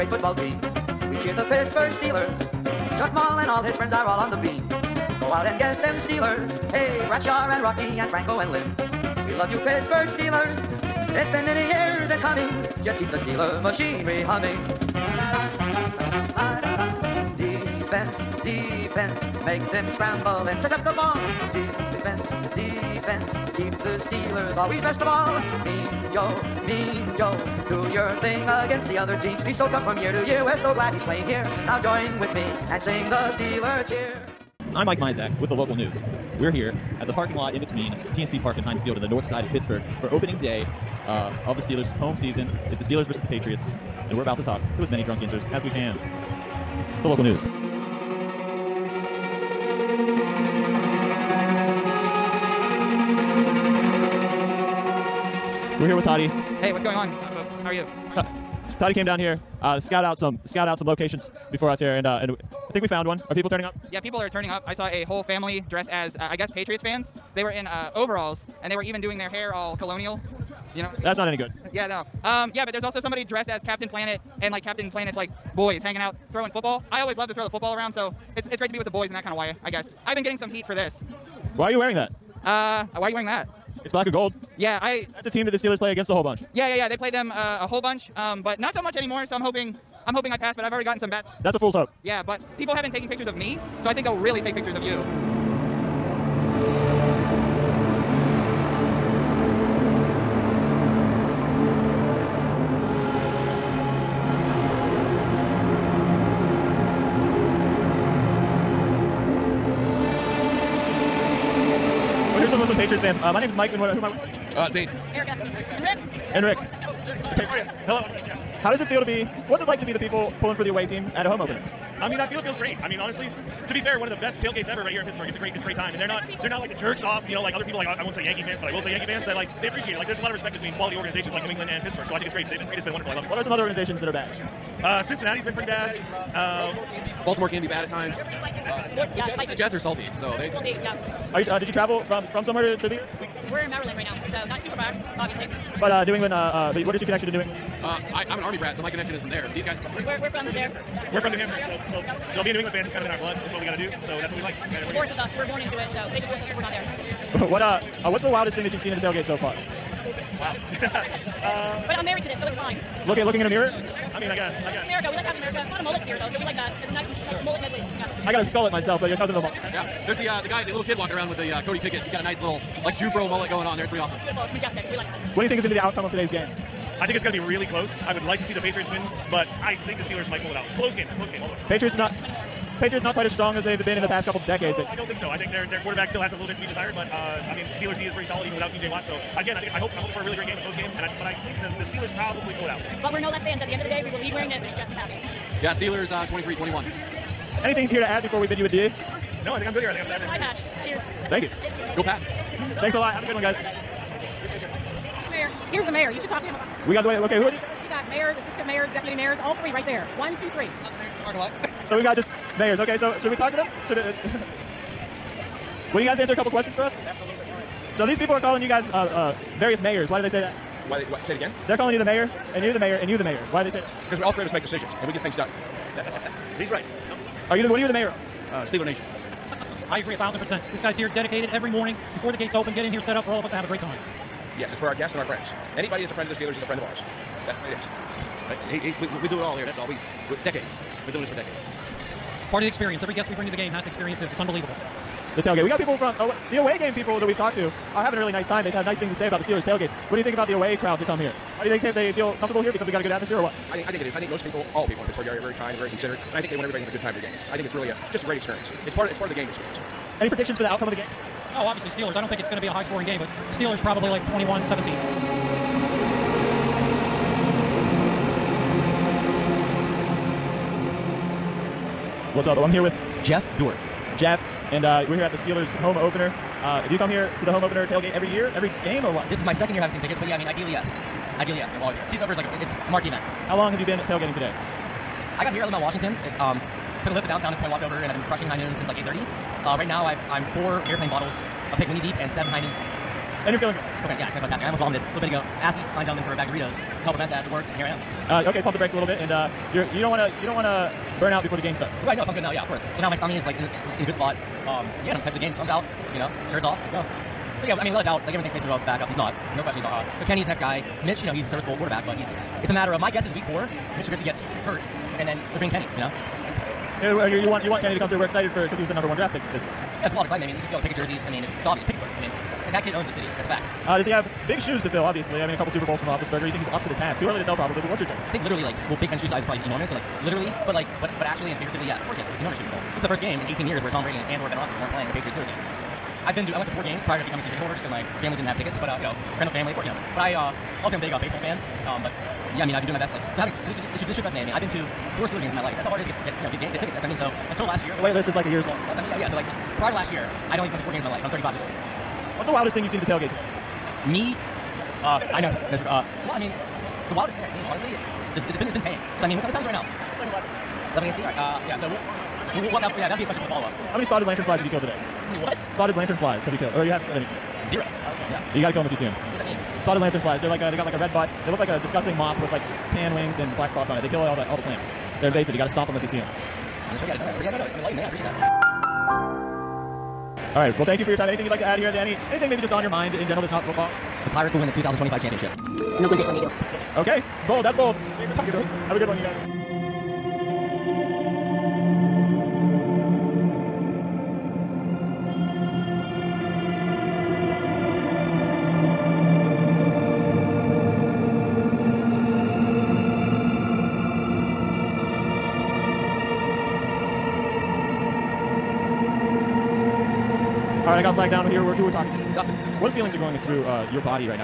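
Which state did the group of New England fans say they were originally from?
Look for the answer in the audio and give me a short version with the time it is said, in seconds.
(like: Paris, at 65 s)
New Hampshire, at 151 s.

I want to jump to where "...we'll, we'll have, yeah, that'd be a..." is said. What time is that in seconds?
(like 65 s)
362 s.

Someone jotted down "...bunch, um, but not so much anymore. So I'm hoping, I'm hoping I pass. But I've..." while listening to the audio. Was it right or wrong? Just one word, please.
right.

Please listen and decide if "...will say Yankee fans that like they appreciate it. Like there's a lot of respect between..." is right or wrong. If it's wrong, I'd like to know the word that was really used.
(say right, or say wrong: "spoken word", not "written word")
right.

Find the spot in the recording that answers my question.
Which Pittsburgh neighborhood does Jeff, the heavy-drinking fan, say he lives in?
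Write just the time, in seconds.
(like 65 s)
285 s.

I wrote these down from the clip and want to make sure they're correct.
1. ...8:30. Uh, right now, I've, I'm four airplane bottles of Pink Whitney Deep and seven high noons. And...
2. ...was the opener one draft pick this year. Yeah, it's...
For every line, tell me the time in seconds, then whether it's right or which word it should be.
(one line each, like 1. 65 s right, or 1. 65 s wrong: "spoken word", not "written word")
1. 288 s right
2. 318 s wrong: "number", not "opener".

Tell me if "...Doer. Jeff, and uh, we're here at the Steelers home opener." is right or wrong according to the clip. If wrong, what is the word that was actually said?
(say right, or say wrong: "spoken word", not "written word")
right.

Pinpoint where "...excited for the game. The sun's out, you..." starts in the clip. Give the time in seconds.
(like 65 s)
305 s.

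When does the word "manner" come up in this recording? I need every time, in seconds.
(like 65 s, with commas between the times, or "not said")
not said.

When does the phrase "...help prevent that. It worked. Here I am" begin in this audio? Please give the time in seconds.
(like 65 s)
297 s.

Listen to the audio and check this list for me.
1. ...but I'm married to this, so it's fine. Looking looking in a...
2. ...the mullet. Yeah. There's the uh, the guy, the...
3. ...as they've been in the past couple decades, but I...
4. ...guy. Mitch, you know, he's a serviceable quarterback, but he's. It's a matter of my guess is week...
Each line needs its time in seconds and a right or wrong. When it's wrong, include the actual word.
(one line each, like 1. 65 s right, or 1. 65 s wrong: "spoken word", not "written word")
1. 161 s right
2. 169 s right
3. 183 s right
4. 310 s right.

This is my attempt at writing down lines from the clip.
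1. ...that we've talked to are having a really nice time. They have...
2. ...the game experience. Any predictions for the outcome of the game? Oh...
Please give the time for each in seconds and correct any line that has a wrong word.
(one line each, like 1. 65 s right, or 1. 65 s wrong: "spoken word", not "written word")
1. 247 s right
2. 259 s right.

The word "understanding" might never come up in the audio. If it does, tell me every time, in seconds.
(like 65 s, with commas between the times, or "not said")
not said.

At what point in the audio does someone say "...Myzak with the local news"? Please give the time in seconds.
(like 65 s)
34 s.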